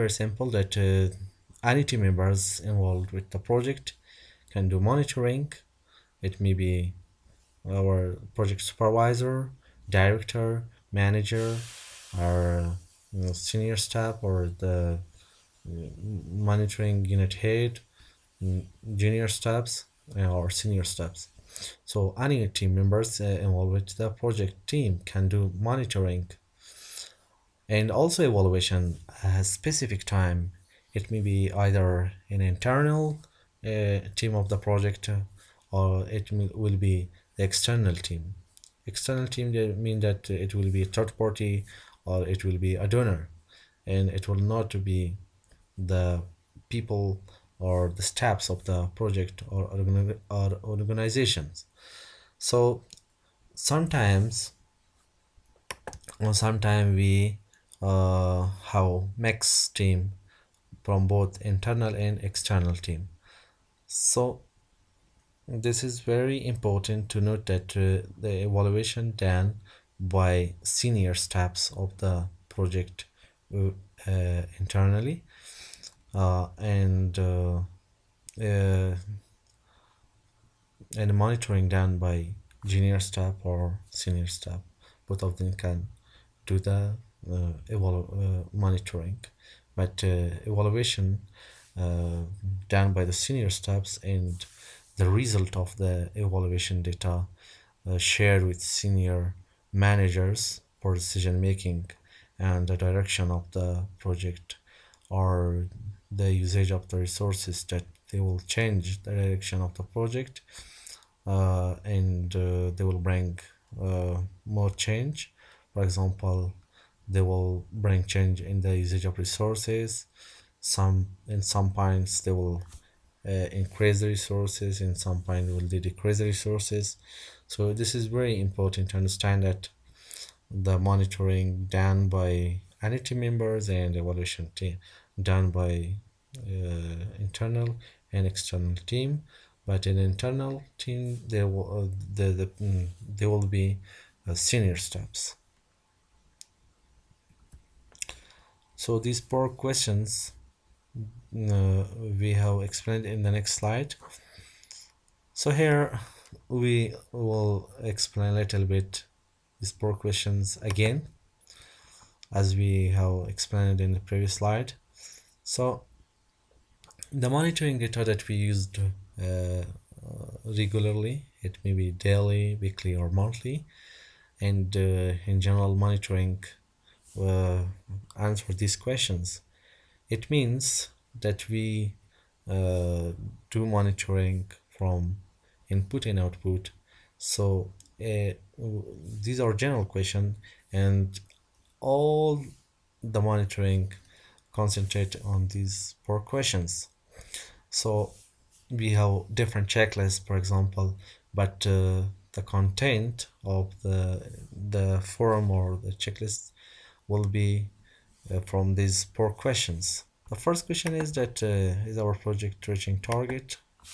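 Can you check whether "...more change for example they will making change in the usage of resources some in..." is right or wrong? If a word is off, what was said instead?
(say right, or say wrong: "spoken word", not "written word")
wrong: "bring", not "making".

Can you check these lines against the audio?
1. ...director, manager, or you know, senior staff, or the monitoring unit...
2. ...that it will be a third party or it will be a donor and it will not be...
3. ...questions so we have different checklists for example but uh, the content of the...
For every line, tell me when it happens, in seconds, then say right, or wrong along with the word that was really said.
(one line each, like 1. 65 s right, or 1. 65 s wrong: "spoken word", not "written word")
1. 9 s right
2. 39 s right
3. 196 s right.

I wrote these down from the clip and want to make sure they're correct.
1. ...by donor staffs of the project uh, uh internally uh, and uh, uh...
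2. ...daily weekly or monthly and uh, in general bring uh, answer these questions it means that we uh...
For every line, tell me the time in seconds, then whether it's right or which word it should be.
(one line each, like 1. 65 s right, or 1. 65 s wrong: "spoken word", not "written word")
1. 69 s wrong: "senior", not "donor"
2. 171 s wrong: "monitoring", not "bring".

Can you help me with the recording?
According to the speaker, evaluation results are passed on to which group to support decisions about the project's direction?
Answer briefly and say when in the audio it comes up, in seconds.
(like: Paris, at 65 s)
Senior managers, at 98 s.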